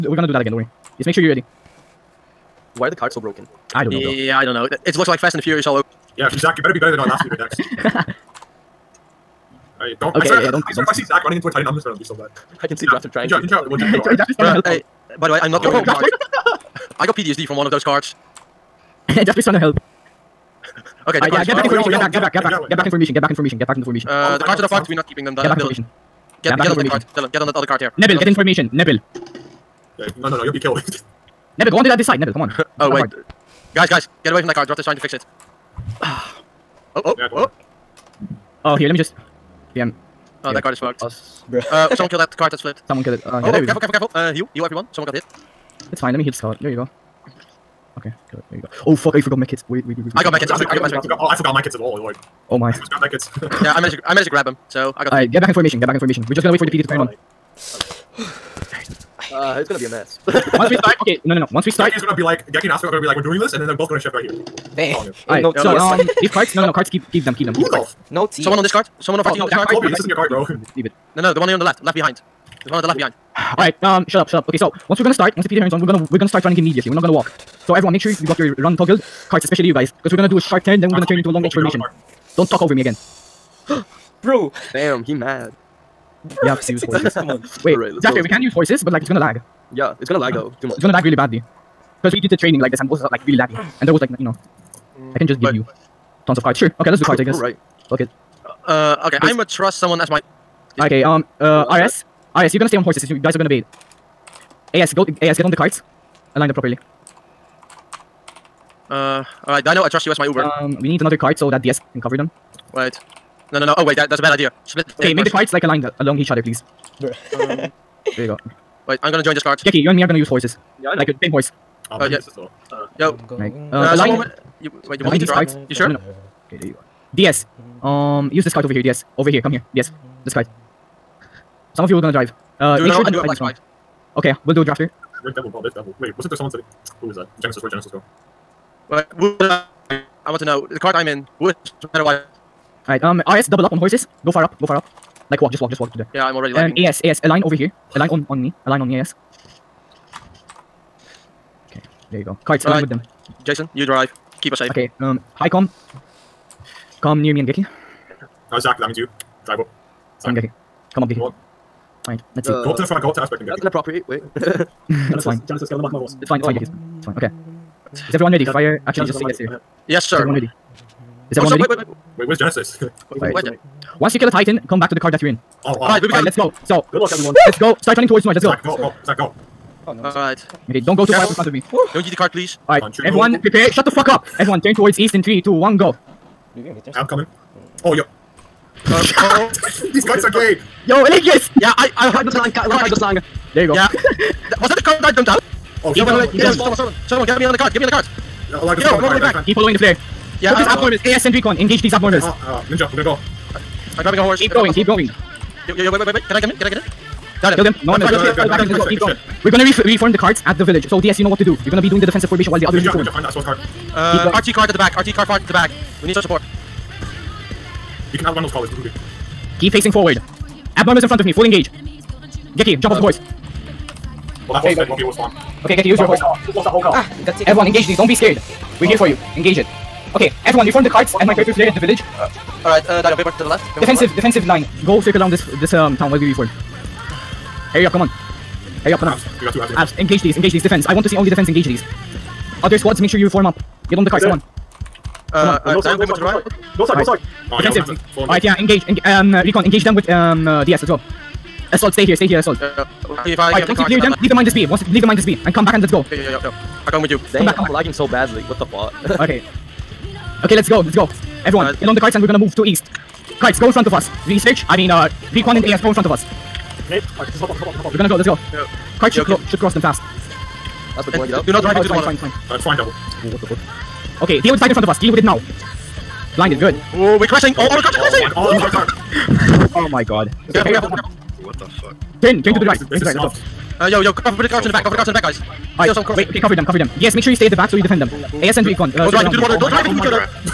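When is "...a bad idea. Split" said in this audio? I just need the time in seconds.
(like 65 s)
114 s.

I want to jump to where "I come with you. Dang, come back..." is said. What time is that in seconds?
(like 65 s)
256 s.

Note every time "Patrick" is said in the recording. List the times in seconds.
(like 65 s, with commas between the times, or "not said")
not said.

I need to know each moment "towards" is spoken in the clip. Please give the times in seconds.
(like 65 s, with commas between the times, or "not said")
178 s, 184 s.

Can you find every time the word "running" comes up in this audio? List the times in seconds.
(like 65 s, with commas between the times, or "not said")
11 s, 76 s.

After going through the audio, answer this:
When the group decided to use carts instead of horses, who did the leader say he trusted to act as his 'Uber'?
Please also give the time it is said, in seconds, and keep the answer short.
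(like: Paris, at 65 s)
Dino, at 109 s.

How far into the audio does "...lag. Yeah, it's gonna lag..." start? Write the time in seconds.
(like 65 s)
89 s.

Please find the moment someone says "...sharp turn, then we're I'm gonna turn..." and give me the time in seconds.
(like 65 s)
80 s.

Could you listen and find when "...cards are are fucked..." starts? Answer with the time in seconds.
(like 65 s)
24 s.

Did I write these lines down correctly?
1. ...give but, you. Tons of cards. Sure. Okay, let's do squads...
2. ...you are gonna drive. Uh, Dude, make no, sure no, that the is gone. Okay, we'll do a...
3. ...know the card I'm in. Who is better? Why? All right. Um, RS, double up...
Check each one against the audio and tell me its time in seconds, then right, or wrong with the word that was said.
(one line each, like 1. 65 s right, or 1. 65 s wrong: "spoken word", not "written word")
1. 95 s wrong: "cards", not "squads"
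2. 131 s right
3. 140 s right.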